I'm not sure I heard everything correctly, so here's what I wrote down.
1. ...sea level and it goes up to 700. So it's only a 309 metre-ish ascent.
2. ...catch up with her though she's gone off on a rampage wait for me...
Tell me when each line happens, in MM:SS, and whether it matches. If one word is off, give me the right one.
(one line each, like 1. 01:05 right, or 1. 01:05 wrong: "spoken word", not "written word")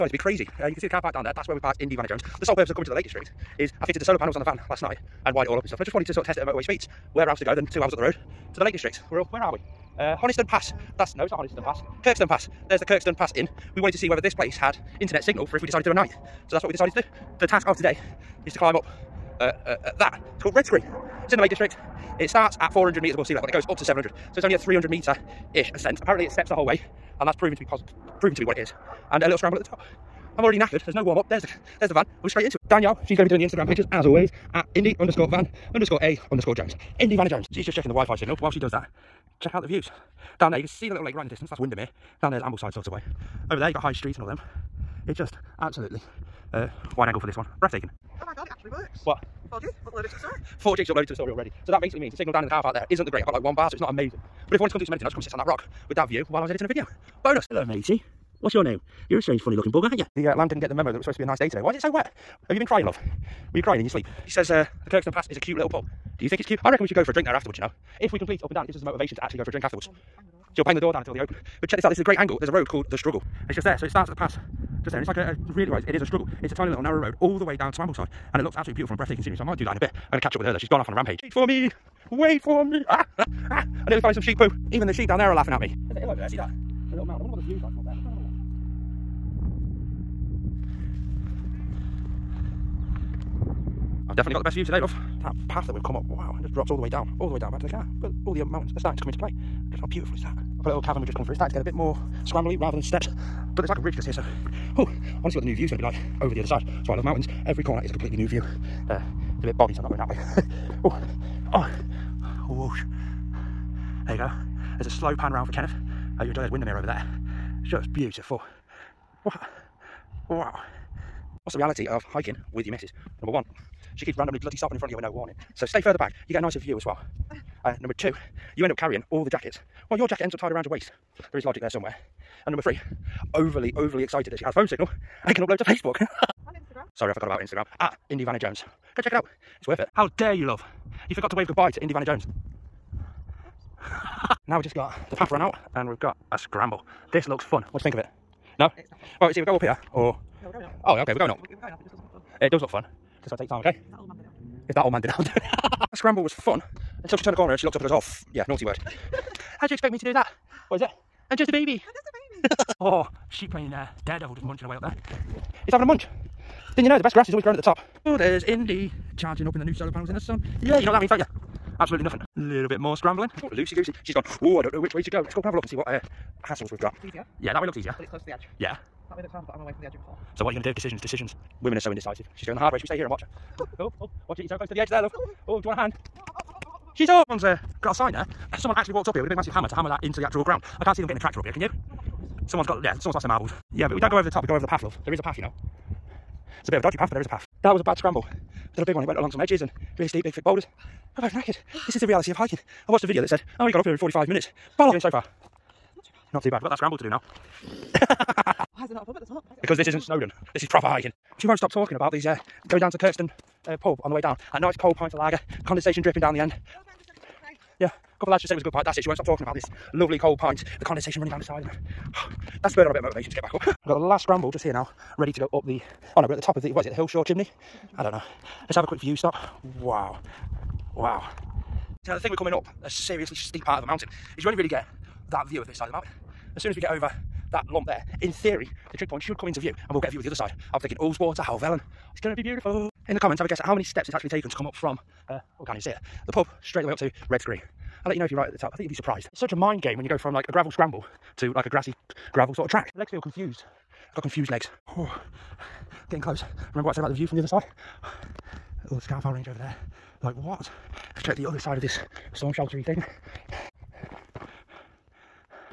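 1. 00:23 wrong: "300", not "309"
2. 01:20 right.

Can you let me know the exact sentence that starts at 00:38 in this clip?
While she does that, check out the views.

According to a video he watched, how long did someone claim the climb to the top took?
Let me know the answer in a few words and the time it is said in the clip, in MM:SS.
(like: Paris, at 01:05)
45 minutes, at 03:23.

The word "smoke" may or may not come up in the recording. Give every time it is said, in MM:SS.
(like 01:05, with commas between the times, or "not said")
not said.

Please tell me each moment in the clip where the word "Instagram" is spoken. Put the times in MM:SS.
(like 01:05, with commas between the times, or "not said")
00:33, 02:17.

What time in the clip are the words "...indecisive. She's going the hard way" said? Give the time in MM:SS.
03:01.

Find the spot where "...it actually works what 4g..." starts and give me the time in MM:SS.
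00:48.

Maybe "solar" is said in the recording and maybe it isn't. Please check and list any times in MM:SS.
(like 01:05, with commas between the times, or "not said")
00:04, 02:49.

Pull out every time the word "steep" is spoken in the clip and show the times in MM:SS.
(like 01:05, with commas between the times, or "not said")
03:20, 03:53.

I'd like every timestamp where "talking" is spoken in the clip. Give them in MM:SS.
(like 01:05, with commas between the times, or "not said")
03:31, 03:39.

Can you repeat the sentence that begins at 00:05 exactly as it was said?
And I just wanted to sort of test it at motorway speeds.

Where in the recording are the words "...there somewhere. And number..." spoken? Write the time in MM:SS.
02:11.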